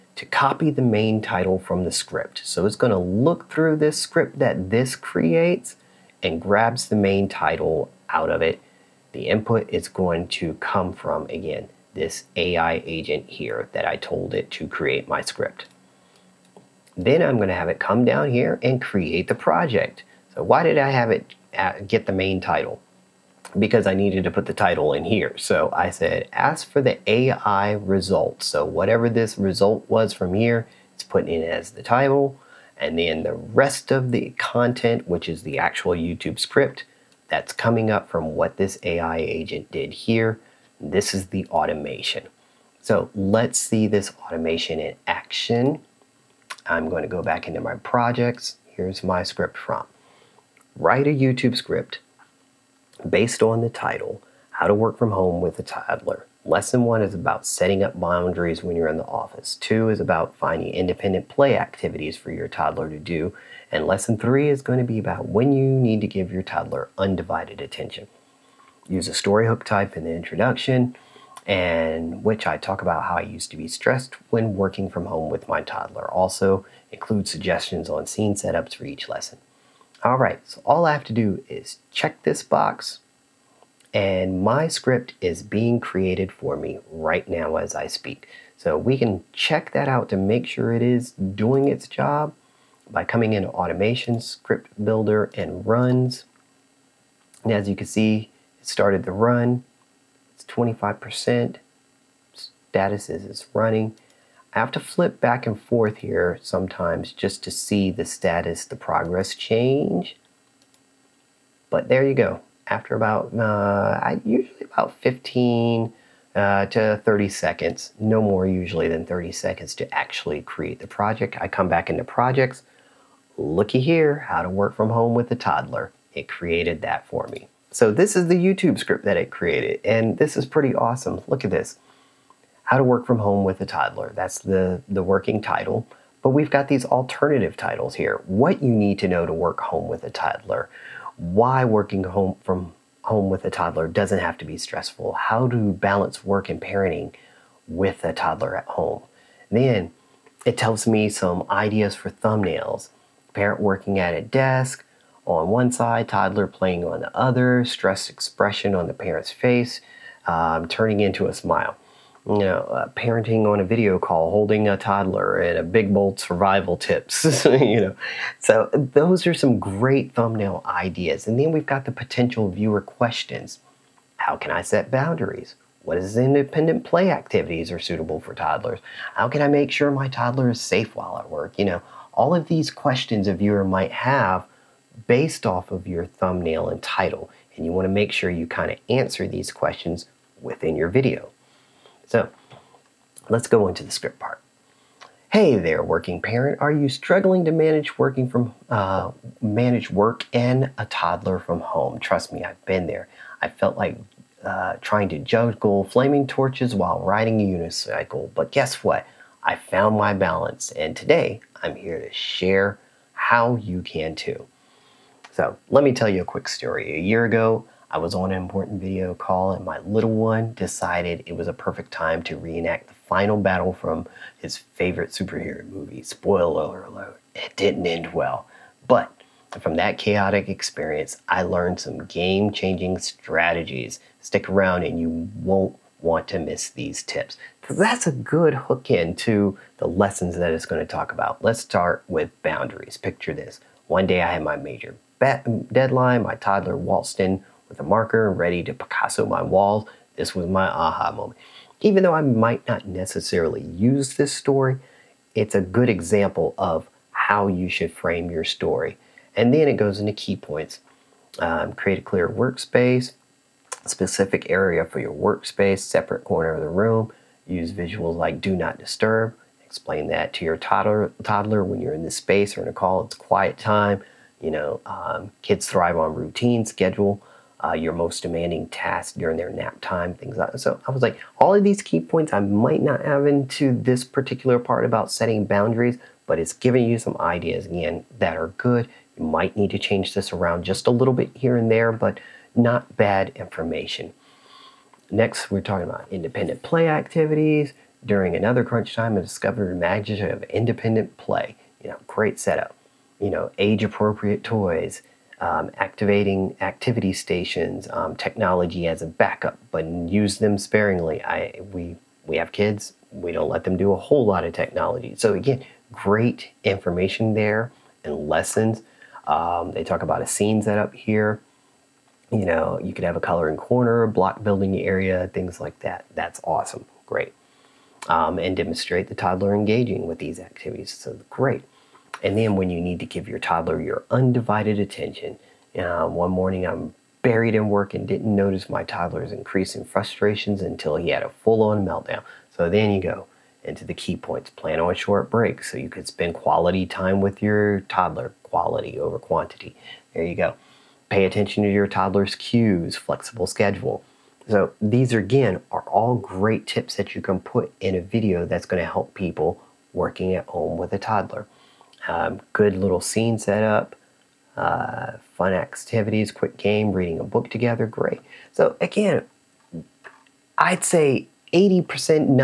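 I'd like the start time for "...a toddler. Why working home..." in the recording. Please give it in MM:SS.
02:20.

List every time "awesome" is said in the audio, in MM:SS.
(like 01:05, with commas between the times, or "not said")
02:10, 05:26.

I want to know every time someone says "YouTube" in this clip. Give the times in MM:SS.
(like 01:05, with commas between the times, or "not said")
00:35, 00:51, 02:08.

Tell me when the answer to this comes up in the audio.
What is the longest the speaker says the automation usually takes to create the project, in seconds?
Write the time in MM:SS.
01:57.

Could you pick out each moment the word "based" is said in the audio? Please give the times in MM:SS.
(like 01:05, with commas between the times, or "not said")
00:53, 03:05.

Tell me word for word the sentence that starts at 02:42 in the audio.
You know, uh, parenting on a video call, holding a toddler, and a big bold survival tips.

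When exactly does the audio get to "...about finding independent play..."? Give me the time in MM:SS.
00:59.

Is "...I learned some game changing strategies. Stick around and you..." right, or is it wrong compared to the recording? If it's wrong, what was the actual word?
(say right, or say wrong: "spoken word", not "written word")
right.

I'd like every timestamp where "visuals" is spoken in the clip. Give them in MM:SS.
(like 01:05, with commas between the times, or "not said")
04:27.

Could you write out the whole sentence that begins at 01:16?
Also include suggestions on scene setups for each lesson.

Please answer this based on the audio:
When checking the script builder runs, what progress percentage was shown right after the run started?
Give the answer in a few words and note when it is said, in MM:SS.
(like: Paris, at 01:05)
25%, at 01:40.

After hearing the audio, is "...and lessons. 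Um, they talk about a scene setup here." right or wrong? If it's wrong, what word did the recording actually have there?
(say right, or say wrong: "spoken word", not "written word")
right.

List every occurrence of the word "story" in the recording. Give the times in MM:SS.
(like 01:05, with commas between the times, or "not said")
01:09, 03:36, 04:14, 04:18.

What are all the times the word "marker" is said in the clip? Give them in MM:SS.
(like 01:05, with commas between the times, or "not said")
04:07.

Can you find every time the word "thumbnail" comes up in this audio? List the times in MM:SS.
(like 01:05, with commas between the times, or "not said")
02:32, 02:50, 03:06.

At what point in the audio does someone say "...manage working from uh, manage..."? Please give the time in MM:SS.
03:17.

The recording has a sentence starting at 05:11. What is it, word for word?
I we we have kids, we don't let them do a whole lot of technology.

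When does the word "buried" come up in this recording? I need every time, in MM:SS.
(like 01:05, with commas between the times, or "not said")
05:37.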